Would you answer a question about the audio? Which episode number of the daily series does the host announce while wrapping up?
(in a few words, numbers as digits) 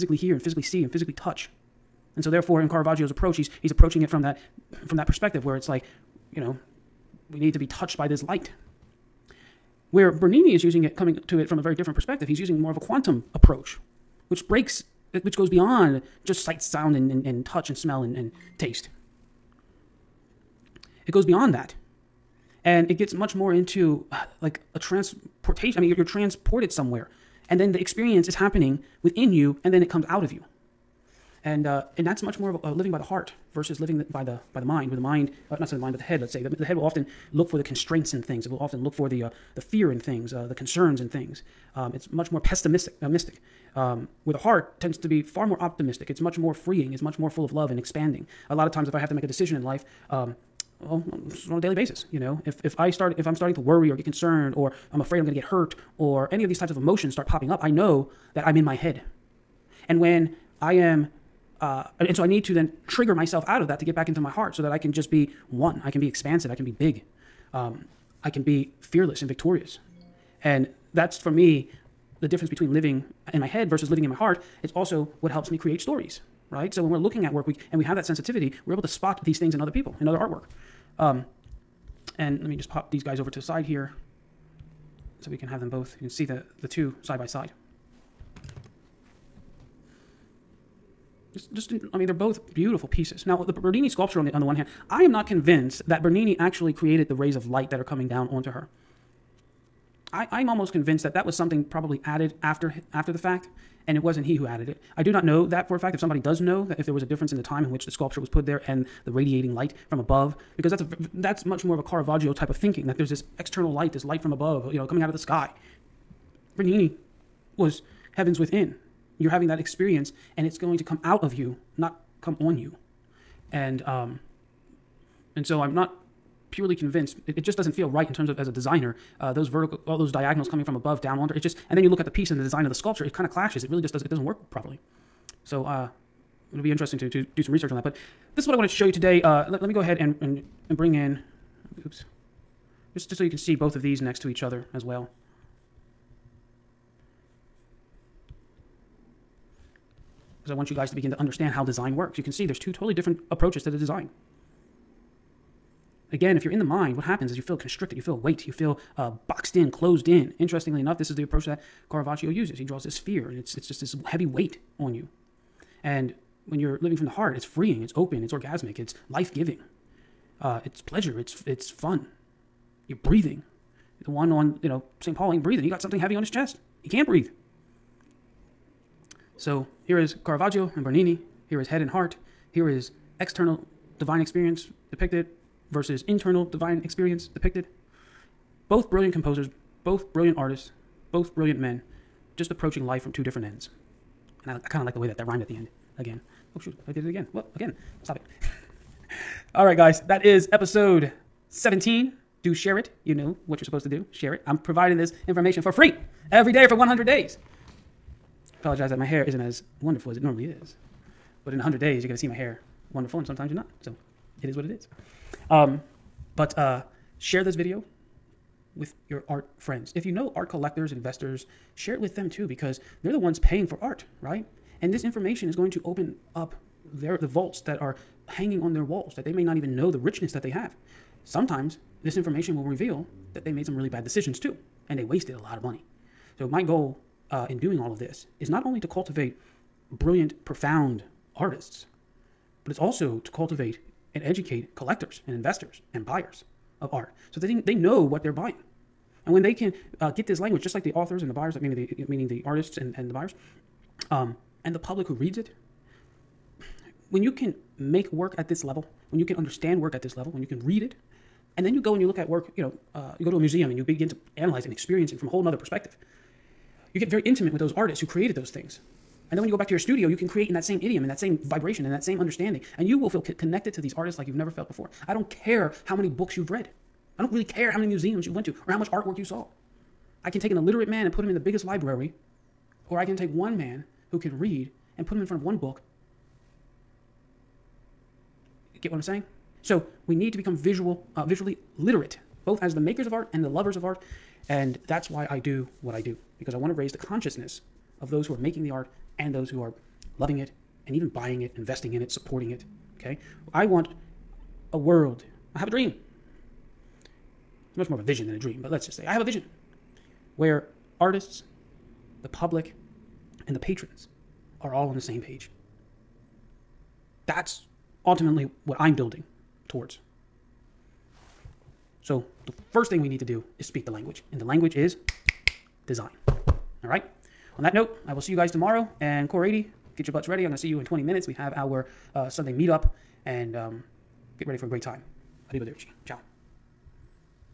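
17.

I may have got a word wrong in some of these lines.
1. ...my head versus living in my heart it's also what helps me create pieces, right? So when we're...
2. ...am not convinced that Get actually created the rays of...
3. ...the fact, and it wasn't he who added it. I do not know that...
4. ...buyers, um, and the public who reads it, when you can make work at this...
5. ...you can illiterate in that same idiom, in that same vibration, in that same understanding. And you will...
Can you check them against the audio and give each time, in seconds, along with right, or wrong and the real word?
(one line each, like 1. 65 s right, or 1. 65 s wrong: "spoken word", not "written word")
1. 73 s wrong: "stories", not "pieces"
2. 95 s wrong: "Bernini", not "Get"
3. 103 s right
4. 253 s right
5. 270 s wrong: "create", not "illiterate".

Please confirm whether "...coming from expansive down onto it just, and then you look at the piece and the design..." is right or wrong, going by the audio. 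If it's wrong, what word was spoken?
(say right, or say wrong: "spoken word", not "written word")
wrong: "above", not "expansive".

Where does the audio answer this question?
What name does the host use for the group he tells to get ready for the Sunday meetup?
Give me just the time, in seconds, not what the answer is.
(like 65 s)
329 s.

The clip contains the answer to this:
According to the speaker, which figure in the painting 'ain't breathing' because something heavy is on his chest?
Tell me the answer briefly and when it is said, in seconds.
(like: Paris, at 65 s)
St. Paul, at 175 s.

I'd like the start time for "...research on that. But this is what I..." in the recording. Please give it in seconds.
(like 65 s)
137 s.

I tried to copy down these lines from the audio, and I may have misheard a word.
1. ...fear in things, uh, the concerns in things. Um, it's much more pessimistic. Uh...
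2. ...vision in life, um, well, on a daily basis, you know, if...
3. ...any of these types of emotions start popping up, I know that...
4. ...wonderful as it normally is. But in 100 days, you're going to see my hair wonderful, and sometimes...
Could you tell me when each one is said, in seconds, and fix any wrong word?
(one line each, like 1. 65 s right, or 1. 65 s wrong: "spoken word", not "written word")
1. 39 s right
2. 49 s wrong: "decision", not "vision"
3. 56 s right
4. 209 s right.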